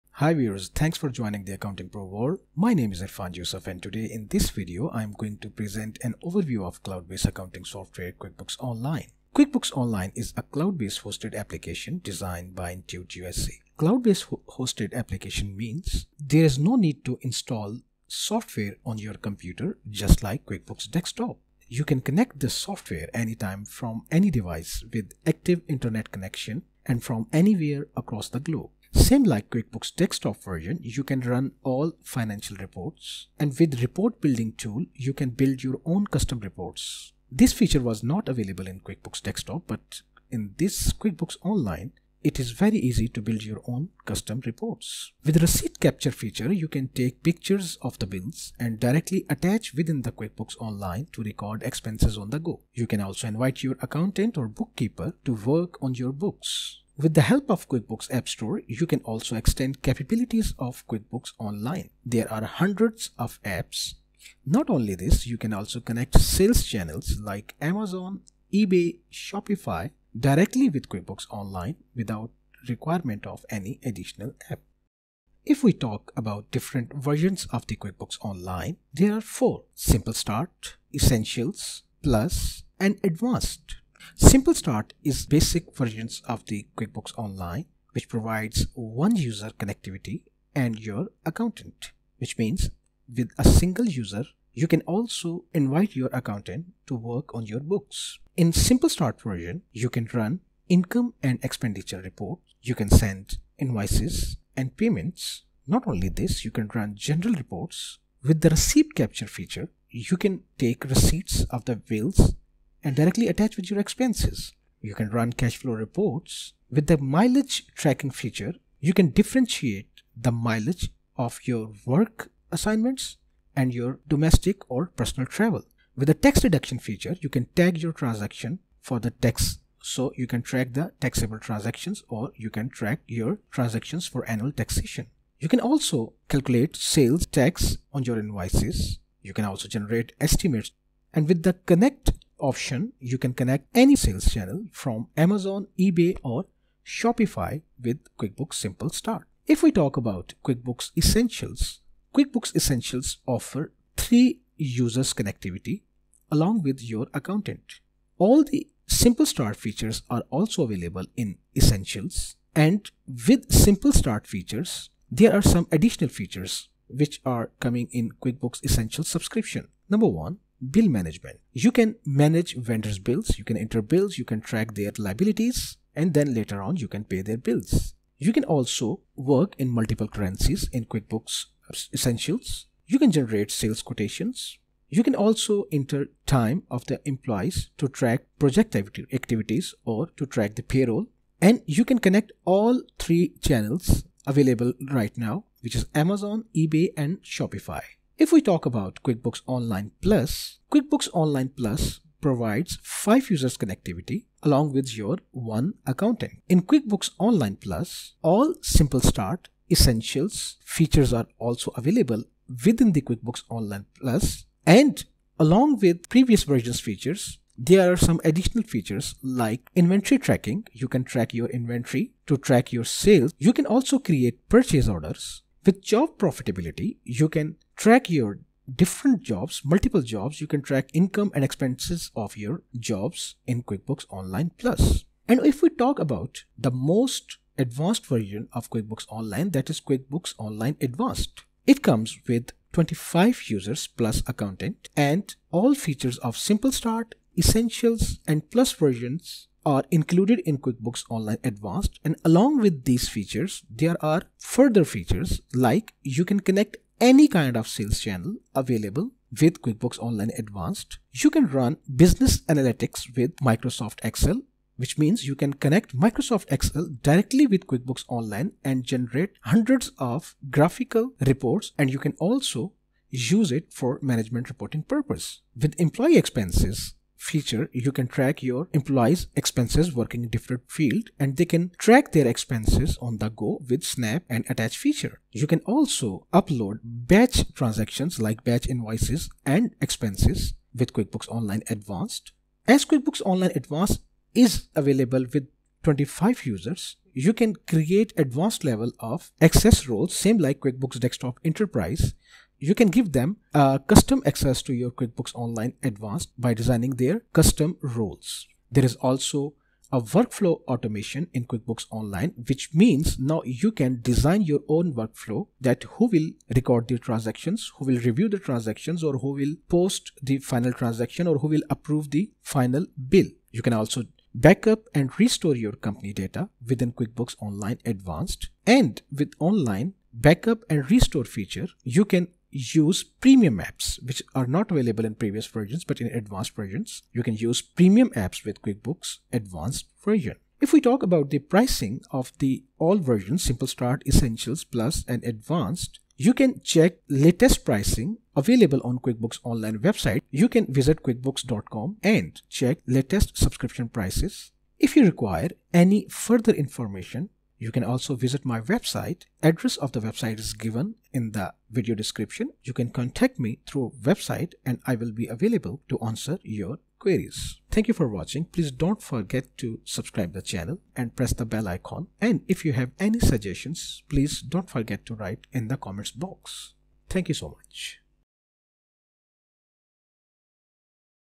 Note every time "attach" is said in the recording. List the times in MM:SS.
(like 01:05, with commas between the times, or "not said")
00:49, 01:53, 04:44.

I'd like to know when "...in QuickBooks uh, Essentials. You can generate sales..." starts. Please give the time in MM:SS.
03:00.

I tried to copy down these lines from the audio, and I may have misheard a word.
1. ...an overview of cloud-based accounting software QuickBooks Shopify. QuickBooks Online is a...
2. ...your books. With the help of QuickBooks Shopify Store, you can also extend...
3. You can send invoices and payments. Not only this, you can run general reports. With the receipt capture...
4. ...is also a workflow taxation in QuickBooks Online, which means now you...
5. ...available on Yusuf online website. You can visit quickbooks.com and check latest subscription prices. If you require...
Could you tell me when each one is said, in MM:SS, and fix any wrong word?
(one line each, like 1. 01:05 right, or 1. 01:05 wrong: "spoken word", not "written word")
1. 00:06 wrong: "Online", not "Shopify"
2. 00:55 wrong: "App", not "Shopify"
3. 01:42 right
4. 05:08 wrong: "automation", not "taxation"
5. 05:48 wrong: "QuickBooks", not "Yusuf".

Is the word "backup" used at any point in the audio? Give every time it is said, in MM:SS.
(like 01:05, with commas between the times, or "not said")
05:24, 05:30.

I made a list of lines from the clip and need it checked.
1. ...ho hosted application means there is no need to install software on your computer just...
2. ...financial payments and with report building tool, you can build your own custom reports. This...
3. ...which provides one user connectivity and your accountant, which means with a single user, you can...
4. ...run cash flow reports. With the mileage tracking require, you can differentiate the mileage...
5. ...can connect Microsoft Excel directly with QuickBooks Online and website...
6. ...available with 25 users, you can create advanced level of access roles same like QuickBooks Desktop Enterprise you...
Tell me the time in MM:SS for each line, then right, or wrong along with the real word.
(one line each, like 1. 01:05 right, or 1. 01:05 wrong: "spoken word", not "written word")
1. 00:14 right
2. 00:32 wrong: "reports", not "payments"
3. 01:27 right
4. 01:55 wrong: "feature", not "require"
5. 04:25 wrong: "generate", not "website"
6. 04:54 right.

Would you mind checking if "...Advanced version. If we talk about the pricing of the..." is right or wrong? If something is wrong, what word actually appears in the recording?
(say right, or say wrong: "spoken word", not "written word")
right.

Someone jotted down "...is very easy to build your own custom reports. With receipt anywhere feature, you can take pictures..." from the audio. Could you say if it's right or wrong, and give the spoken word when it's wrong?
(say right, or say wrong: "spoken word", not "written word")
wrong: "capture", not "anywhere".